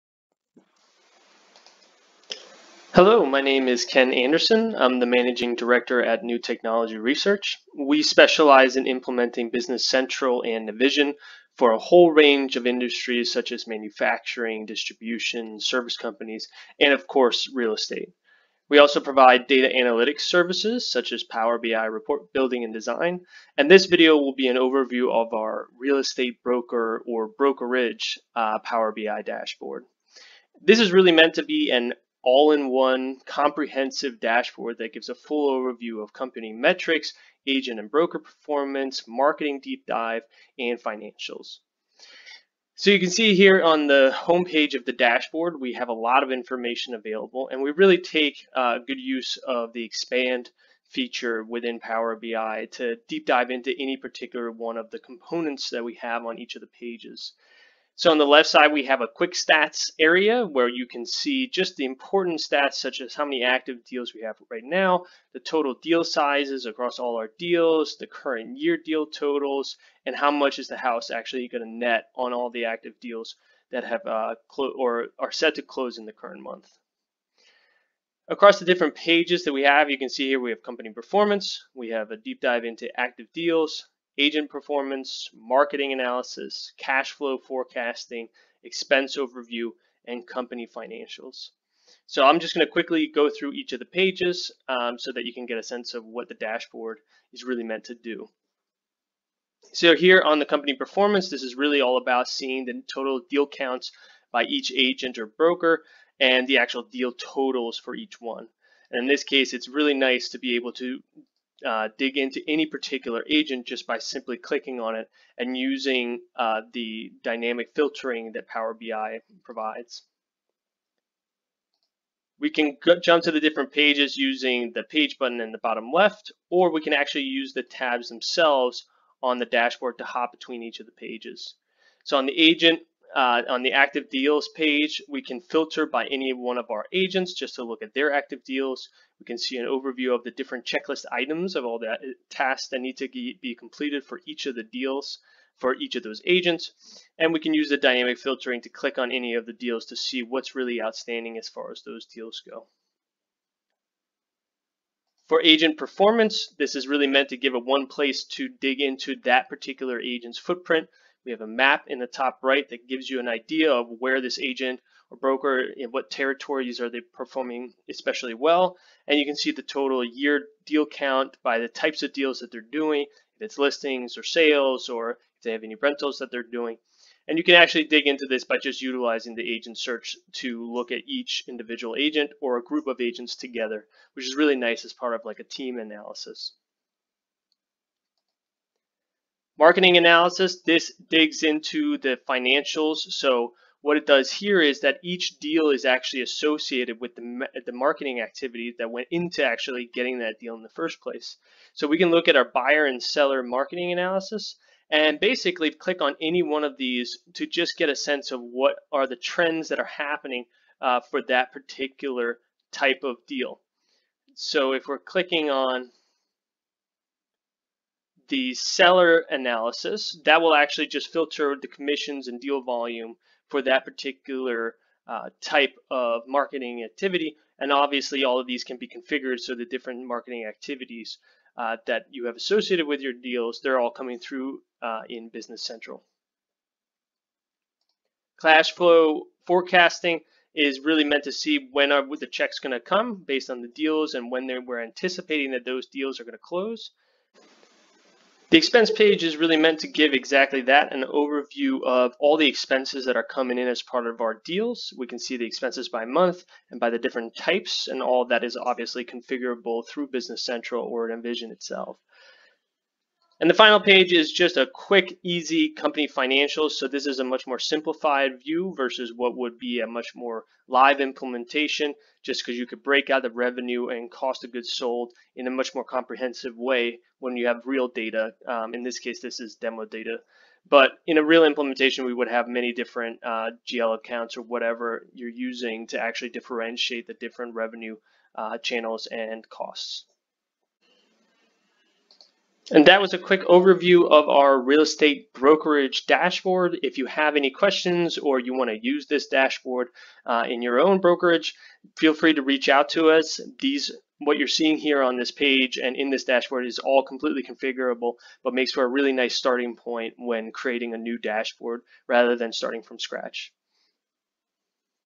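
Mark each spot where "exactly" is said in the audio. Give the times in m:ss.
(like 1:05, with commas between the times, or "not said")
4:10.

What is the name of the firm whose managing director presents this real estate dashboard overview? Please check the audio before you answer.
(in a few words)
New Technology Research.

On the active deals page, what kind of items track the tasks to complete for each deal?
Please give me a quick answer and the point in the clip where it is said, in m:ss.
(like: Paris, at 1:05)
checklist items, at 2:20.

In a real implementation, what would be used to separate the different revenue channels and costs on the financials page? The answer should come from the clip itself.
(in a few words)
GL accounts.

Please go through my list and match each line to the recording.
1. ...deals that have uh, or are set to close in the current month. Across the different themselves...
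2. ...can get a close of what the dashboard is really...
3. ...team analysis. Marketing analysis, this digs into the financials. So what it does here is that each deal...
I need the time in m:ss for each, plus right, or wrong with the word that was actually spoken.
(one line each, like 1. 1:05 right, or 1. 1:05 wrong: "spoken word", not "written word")
1. 1:12 wrong: "pages", not "themselves"
2. 1:35 wrong: "sense", not "close"
3. 3:05 right.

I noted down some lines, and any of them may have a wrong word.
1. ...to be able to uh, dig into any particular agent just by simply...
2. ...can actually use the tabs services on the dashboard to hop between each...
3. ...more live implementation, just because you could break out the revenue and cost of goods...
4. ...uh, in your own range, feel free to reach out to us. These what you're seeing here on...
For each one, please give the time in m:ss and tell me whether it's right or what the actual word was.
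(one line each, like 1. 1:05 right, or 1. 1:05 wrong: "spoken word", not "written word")
1. 1:50 right
2. 2:06 wrong: "themselves", not "services"
3. 4:30 right
4. 5:00 wrong: "brokerage", not "range".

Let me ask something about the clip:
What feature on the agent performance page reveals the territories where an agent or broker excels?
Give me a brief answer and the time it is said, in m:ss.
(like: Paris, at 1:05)
a map, at 2:41.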